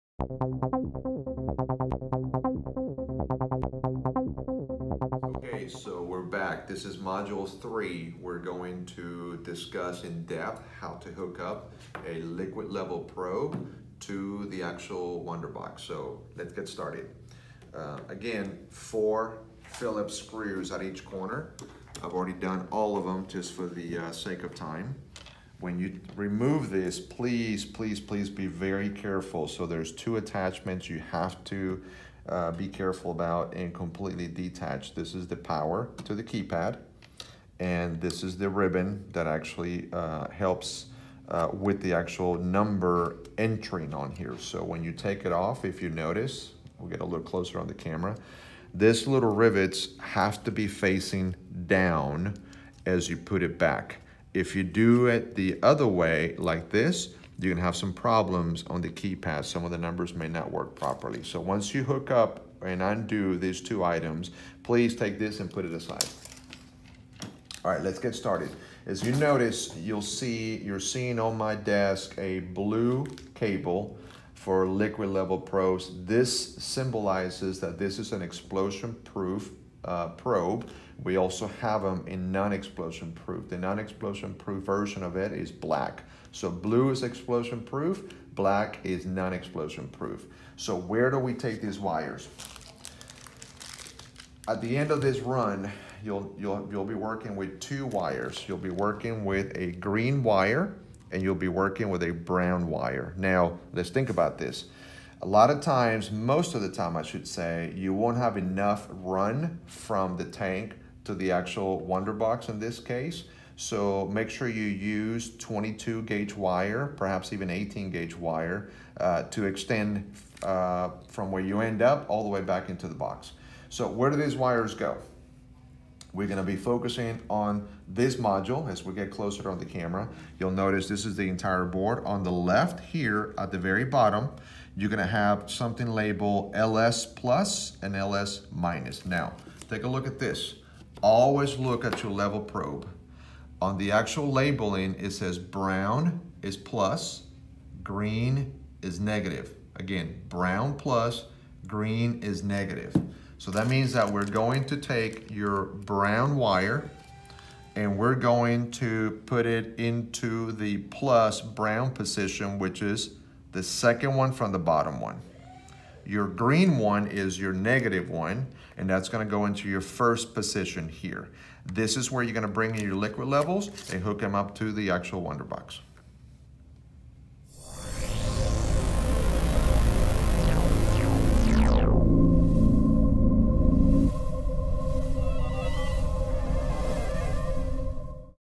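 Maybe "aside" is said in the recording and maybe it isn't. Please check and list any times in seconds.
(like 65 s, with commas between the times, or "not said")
65 s.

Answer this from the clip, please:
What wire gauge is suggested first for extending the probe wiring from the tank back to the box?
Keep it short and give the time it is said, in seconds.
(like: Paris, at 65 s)
22 gauge, at 115 s.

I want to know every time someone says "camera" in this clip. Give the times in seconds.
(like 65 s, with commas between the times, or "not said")
47 s, 129 s.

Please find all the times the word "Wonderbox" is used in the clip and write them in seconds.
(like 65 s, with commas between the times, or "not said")
15 s, 111 s, 175 s.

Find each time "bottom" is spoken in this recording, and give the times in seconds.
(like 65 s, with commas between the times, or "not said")
133 s, 164 s.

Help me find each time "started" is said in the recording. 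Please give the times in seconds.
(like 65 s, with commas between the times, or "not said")
16 s, 68 s.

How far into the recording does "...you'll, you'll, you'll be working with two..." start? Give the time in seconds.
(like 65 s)
96 s.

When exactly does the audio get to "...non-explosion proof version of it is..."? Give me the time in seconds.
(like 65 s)
83 s.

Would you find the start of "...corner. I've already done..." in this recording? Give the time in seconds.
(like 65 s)
21 s.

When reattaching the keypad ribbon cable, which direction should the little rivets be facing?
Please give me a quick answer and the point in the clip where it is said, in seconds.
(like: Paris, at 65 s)
Down, at 50 s.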